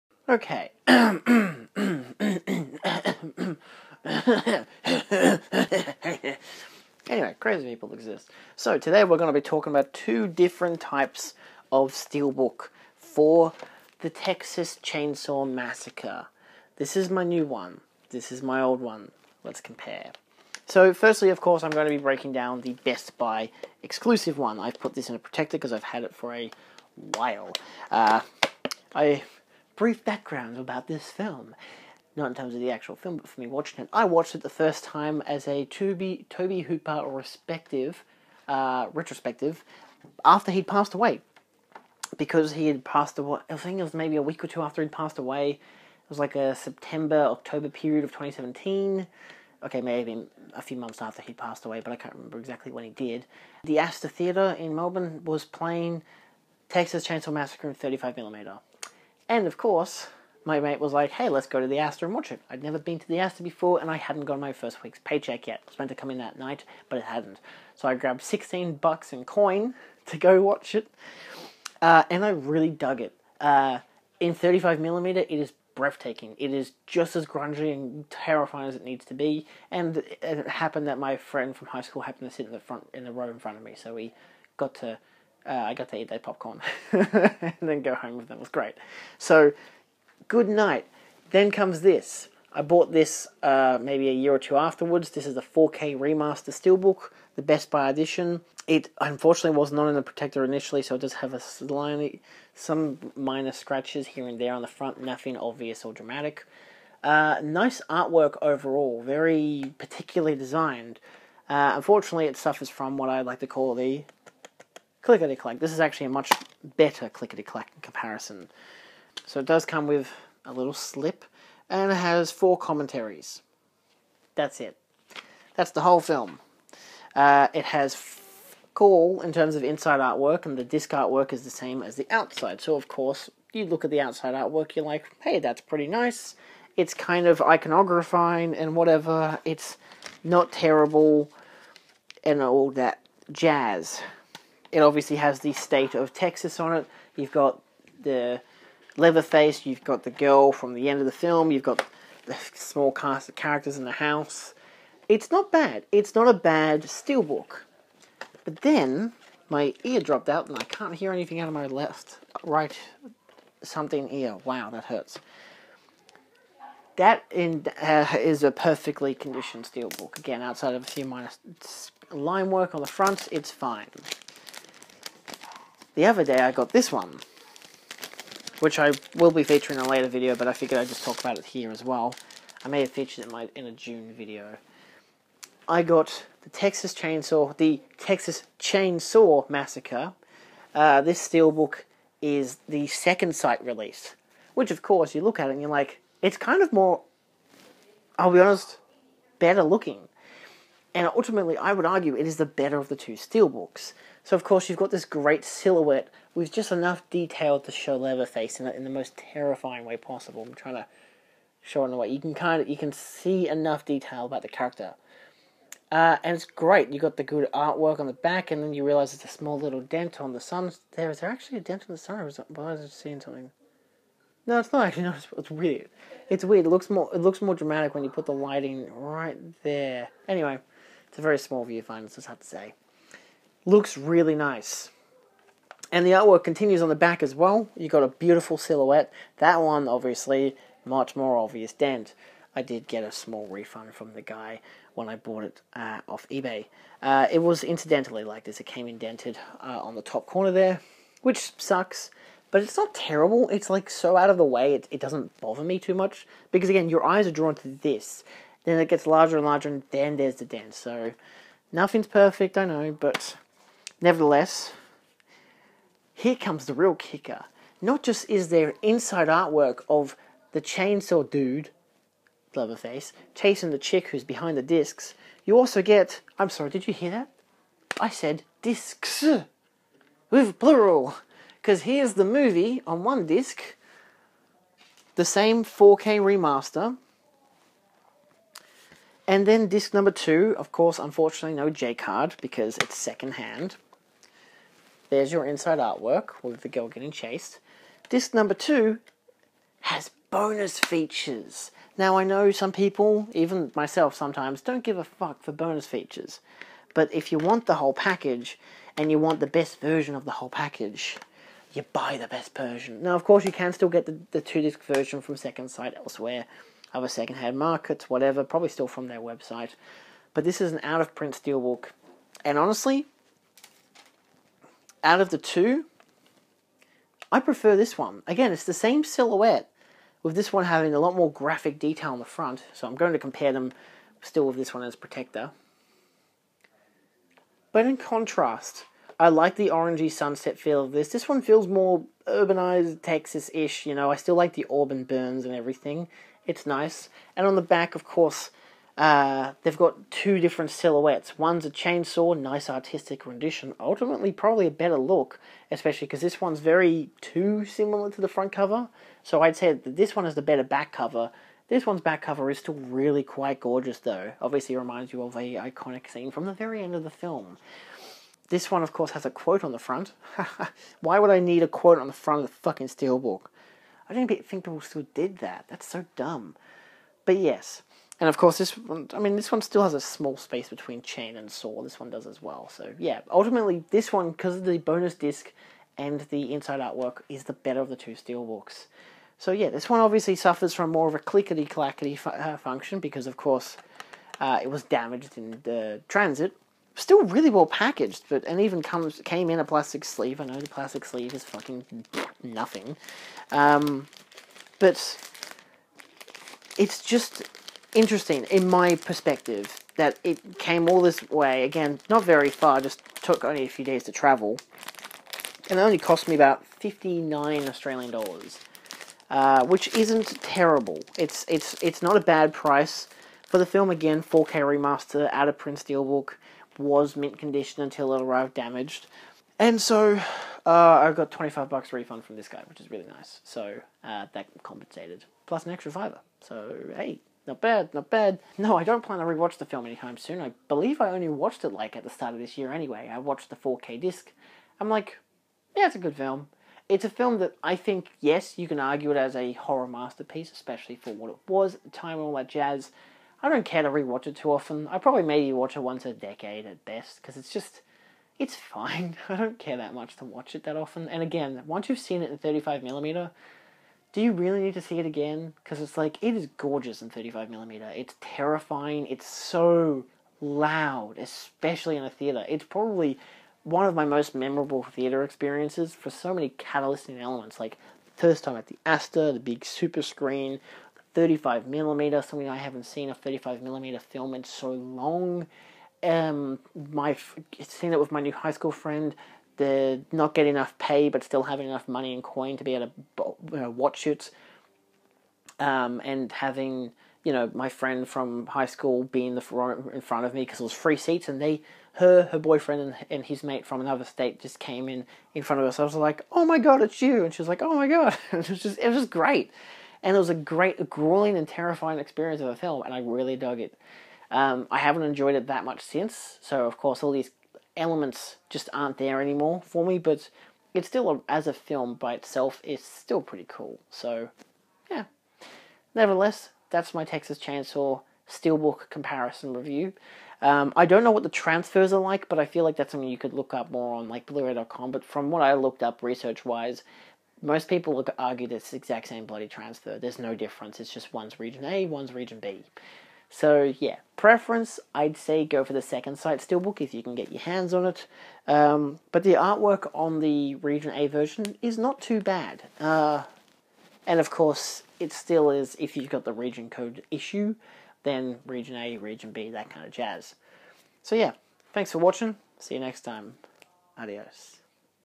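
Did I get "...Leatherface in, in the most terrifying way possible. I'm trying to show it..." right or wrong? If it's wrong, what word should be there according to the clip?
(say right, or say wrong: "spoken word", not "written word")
right.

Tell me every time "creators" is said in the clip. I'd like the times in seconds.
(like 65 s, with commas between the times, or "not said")
not said.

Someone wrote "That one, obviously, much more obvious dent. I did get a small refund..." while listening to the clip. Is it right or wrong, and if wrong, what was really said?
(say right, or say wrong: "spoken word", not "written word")
right.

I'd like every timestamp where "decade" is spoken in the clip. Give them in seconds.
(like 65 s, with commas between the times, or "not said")
456 s.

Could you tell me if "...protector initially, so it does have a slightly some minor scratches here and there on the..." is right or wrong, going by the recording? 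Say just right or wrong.
right.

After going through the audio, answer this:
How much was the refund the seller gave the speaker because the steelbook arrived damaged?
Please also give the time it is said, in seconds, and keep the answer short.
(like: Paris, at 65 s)
25 dollars, at 431 s.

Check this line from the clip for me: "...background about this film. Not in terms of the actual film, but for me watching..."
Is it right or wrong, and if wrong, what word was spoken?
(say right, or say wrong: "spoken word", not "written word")
right.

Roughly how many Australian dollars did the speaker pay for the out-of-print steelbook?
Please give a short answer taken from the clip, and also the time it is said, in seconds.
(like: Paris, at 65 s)
59, at 416 s.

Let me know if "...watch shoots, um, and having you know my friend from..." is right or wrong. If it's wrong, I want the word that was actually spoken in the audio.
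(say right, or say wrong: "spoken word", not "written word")
right.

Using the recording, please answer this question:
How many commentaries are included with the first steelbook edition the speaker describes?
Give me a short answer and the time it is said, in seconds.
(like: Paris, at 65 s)
4, at 122 s.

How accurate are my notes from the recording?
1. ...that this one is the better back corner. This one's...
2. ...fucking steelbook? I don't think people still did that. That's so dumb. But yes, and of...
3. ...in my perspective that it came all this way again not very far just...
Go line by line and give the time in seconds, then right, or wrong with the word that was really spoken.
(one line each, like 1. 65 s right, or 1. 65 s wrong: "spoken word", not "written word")
1. 359 s wrong: "cover", not "corner"
2. 372 s right
3. 408 s right.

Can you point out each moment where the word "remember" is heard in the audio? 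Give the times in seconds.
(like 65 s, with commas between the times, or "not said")
52 s.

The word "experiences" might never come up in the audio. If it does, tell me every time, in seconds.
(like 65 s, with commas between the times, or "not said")
475 s, 511 s.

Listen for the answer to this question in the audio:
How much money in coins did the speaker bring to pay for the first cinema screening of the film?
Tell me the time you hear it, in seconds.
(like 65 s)
68 s.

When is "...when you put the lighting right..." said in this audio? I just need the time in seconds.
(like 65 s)
227 s.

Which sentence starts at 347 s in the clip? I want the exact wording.
And on the back, of course, uh, they've got two different silhouettes.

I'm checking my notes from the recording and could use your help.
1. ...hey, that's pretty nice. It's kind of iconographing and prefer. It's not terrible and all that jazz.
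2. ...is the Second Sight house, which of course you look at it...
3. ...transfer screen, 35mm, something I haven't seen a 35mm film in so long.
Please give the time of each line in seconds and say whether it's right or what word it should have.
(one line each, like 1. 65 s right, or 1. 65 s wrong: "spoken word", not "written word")
1. 135 s wrong: "whatever", not "prefer"
2. 192 s wrong: "release", not "house"
3. 479 s wrong: "super", not "transfer".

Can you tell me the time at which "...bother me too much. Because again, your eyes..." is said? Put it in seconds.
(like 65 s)
255 s.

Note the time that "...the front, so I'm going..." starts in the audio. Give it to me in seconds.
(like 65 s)
332 s.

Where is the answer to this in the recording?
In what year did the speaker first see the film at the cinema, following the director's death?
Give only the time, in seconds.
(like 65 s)
48 s.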